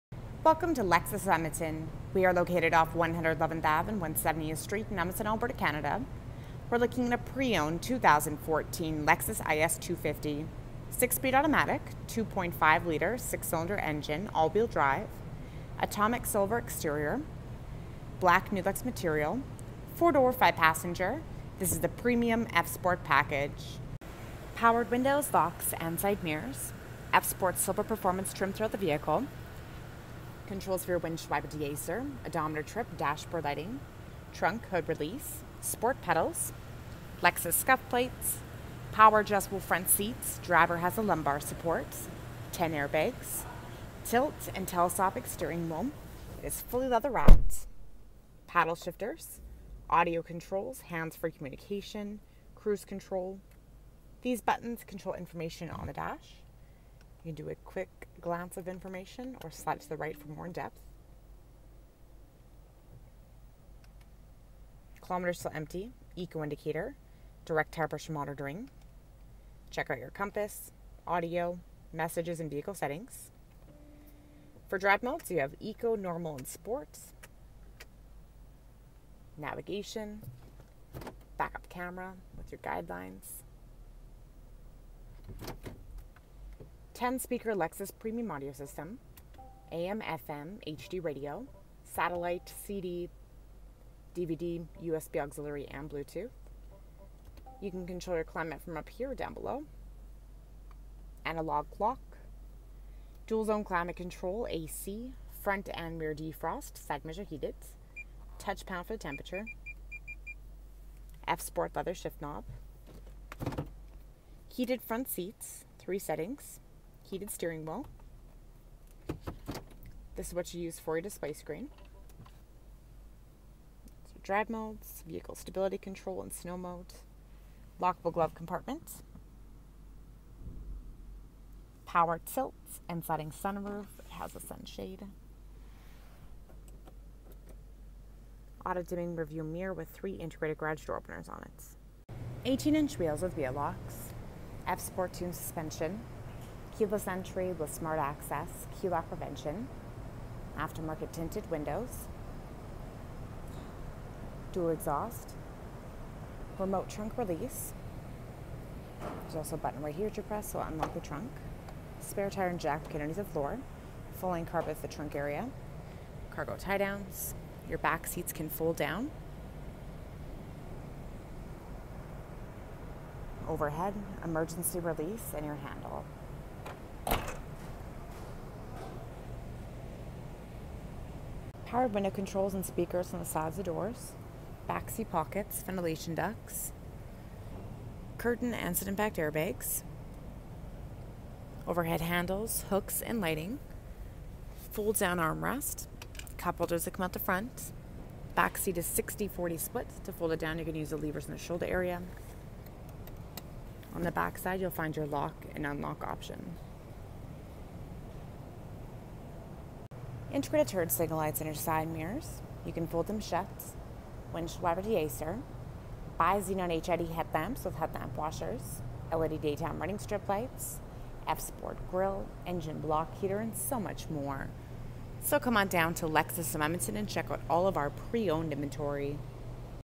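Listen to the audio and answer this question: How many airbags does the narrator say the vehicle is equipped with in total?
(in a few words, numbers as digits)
10.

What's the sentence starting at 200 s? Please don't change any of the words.
To fold it down, you're going to use the levers in the shoulder area.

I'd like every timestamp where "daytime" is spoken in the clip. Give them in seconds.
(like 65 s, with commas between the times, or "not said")
219 s.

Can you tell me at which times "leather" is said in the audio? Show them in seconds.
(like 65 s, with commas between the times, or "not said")
46 s, 111 s.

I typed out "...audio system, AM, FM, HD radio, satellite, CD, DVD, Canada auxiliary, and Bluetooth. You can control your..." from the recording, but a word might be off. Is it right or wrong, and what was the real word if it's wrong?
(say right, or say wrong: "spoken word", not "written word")
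wrong: "USB", not "Canada".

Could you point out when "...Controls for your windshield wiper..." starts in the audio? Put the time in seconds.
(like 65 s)
30 s.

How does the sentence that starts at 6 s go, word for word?
We're looking at a pre-owned 2014 Lexus IS 250.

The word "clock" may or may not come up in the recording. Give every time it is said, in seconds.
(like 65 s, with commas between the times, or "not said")
101 s.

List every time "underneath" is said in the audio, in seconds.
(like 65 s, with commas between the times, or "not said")
162 s.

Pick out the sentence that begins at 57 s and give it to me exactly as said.
You do a quick glance of information or slide to the right for more in depth.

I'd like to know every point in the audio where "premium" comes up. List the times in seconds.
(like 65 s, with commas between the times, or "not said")
21 s, 87 s.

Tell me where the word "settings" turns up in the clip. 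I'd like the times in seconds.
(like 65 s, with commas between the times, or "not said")
72 s, 115 s.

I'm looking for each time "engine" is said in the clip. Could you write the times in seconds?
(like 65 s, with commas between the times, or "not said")
13 s, 222 s.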